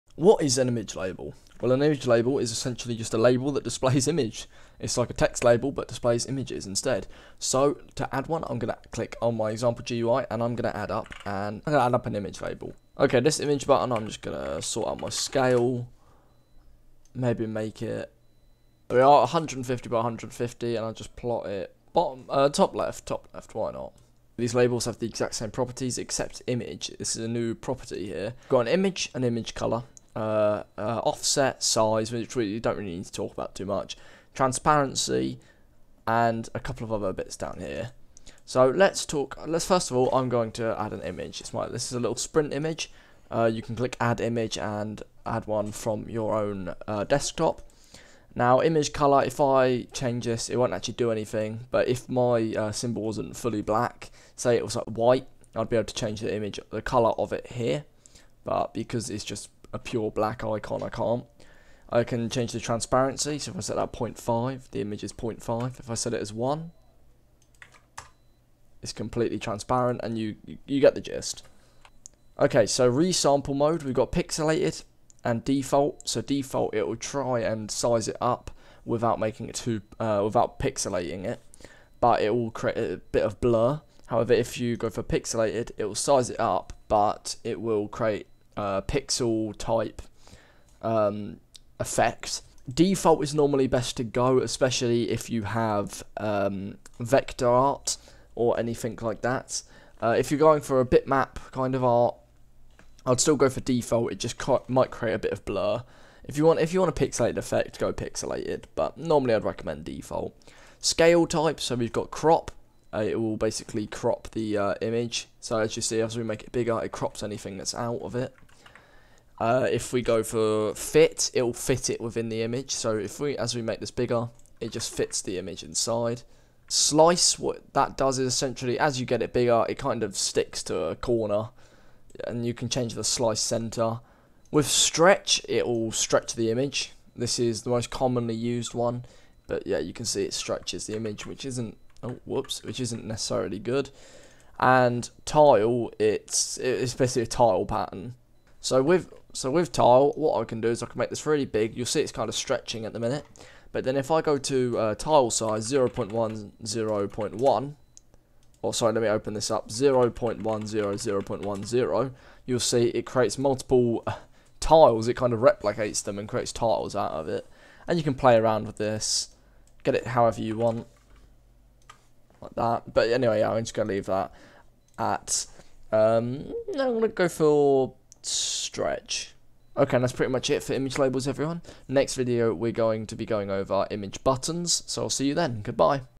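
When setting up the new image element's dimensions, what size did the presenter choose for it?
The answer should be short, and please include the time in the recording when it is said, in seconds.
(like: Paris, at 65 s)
150 by 150, at 19 s.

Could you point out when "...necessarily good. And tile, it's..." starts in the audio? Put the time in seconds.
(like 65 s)
143 s.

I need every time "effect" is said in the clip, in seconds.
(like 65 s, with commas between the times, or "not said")
91 s, 107 s.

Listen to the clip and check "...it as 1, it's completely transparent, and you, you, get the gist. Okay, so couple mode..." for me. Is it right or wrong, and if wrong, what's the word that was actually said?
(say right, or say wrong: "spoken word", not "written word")
wrong: "resample", not "couple".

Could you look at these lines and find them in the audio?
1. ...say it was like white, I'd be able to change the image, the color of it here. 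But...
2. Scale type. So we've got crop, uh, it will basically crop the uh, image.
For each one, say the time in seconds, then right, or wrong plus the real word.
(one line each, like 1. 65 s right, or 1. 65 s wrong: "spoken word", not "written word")
1. 54 s right
2. 110 s right.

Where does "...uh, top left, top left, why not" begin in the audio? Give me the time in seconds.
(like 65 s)
22 s.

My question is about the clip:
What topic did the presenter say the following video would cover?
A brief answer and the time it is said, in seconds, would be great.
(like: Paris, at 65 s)
Image buttons, at 183 s.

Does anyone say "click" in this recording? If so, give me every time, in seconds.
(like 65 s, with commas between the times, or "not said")
8 s, 43 s.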